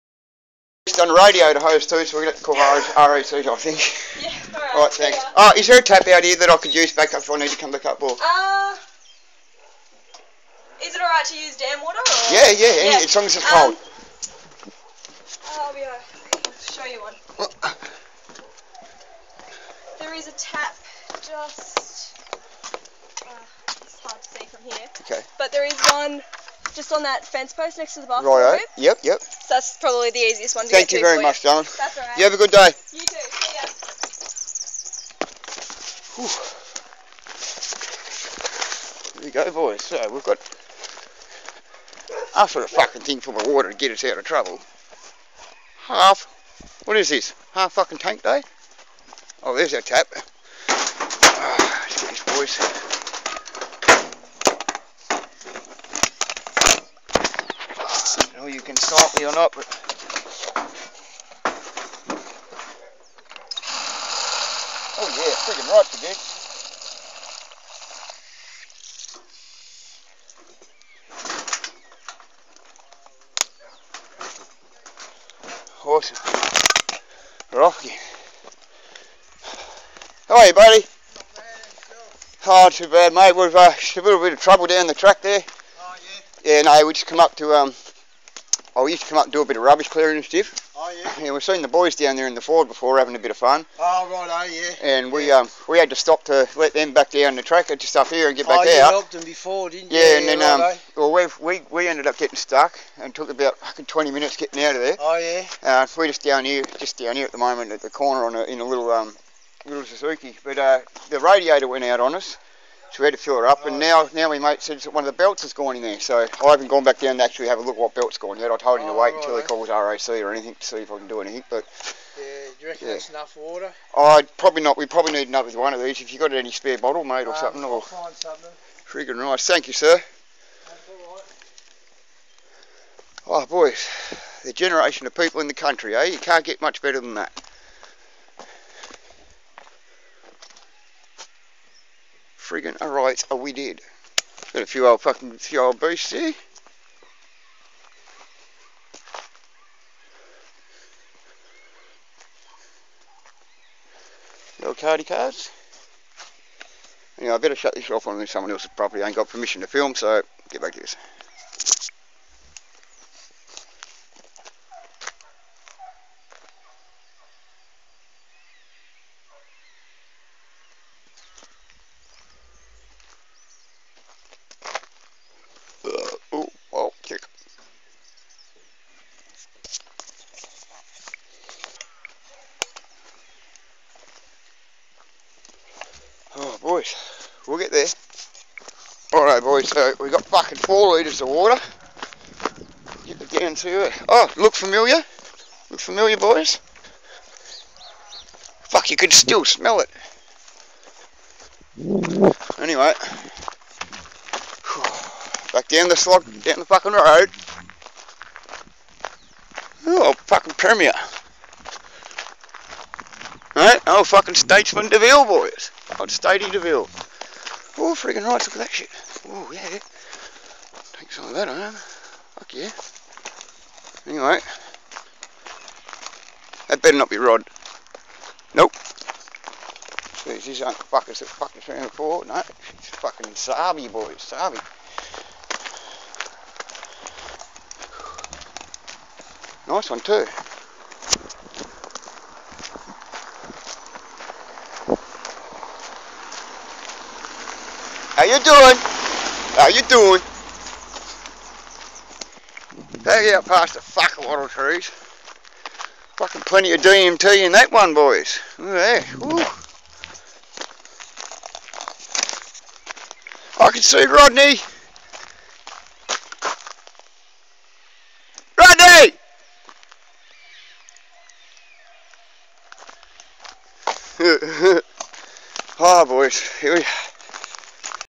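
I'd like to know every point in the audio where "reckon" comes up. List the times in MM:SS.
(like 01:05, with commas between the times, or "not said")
02:02.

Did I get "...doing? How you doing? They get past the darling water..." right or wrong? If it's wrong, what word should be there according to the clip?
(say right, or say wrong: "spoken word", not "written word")
wrong: "fucking", not "darling".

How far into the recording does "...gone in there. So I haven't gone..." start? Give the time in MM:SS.
01:55.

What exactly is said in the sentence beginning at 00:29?
So that's probably the easiest one to Thank you very much, darling.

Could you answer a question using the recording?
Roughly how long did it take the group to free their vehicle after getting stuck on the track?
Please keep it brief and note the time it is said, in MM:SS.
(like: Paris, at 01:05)
20 minutes, at 01:43.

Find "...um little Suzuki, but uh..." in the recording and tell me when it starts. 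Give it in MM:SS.
01:48.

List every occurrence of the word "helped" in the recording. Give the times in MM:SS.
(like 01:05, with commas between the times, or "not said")
01:38.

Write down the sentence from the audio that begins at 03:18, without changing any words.
Fuck, you can still smell it.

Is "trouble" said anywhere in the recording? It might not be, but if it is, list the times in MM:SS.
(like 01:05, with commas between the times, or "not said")
00:44, 01:24.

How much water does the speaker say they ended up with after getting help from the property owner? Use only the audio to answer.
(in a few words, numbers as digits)
4 litres.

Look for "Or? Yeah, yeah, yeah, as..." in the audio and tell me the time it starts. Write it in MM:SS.
00:11.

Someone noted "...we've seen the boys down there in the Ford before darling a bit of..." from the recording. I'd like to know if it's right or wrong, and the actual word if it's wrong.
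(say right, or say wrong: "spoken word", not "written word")
wrong: "having", not "darling".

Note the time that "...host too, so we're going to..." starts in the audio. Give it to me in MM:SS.
00:01.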